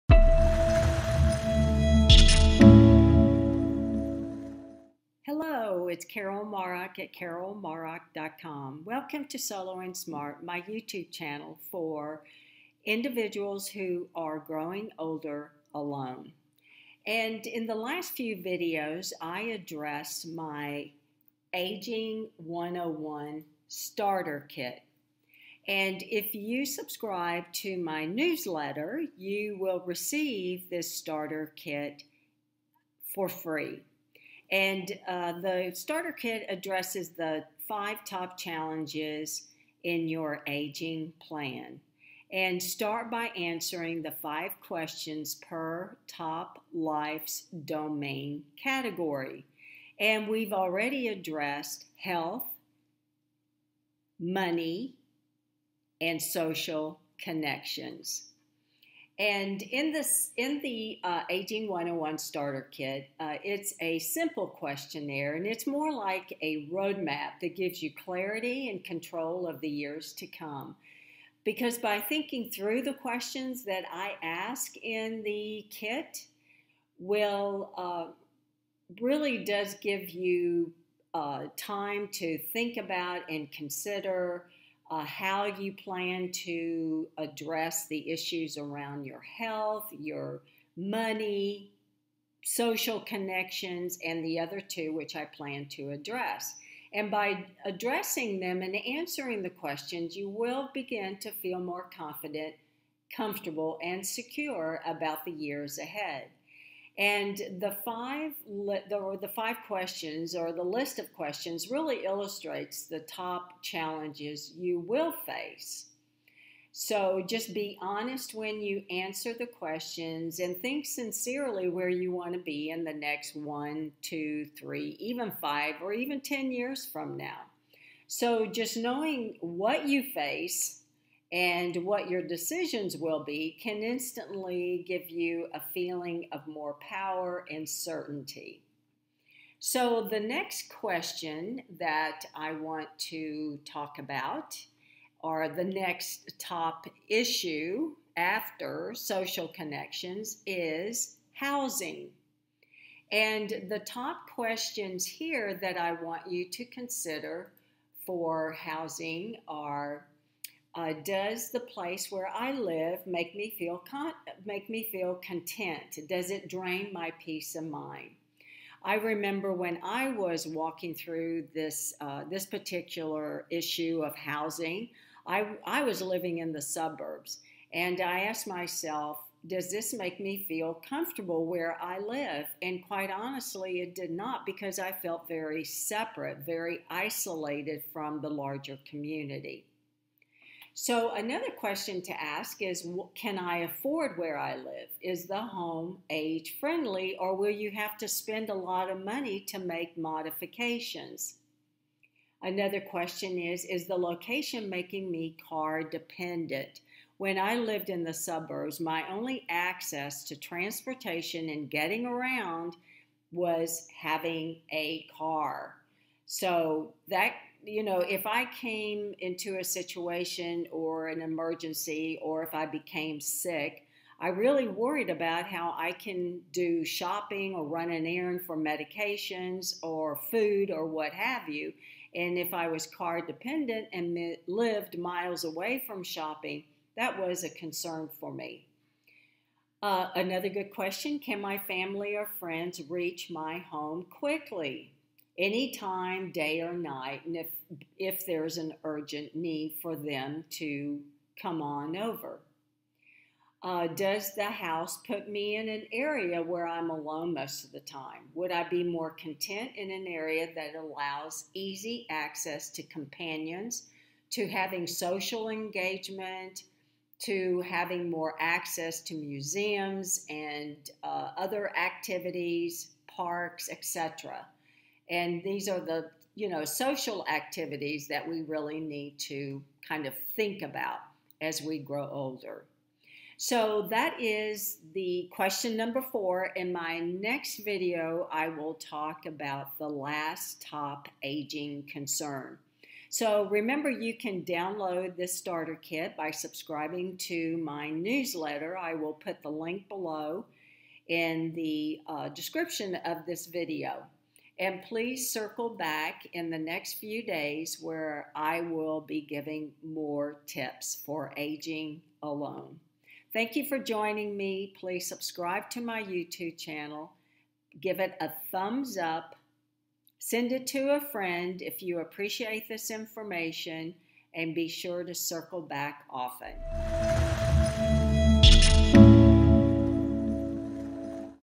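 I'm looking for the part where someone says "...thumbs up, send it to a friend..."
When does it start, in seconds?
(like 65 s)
318 s.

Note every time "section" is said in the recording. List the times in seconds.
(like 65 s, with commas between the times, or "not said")
not said.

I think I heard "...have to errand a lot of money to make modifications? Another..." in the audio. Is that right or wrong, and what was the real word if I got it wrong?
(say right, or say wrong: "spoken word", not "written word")
wrong: "spend", not "errand".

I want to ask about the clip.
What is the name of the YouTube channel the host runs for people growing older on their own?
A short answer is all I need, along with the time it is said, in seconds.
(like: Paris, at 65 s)
Solo and Smart, at 9 s.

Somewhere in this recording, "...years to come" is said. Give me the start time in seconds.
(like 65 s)
69 s.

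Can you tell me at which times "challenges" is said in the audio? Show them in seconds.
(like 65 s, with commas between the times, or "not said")
38 s, 113 s.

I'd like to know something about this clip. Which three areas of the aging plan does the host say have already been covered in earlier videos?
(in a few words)
health, money, and social connections.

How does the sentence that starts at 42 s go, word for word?
And start by answering the five questions per top life's domain category.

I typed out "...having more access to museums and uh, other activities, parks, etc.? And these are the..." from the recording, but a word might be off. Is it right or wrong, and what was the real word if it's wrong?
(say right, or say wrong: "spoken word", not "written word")
right.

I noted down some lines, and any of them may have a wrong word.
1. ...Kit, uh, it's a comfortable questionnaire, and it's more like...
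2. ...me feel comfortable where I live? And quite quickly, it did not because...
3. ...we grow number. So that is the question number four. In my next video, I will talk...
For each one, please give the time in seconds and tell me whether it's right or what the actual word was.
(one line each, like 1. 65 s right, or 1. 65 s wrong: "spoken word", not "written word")
1. 62 s wrong: "simple", not "comfortable"
2. 180 s wrong: "honestly", not "quickly"
3. 281 s wrong: "older", not "number".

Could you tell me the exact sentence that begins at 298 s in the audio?
I will put the link below in the uh, description of this video.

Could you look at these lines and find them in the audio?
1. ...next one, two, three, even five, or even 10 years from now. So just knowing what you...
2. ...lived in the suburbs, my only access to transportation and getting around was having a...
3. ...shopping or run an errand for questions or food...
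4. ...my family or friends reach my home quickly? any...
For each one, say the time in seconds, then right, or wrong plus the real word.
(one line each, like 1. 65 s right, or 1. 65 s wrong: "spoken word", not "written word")
1. 122 s right
2. 207 s right
3. 226 s wrong: "medications", not "questions"
4. 241 s right.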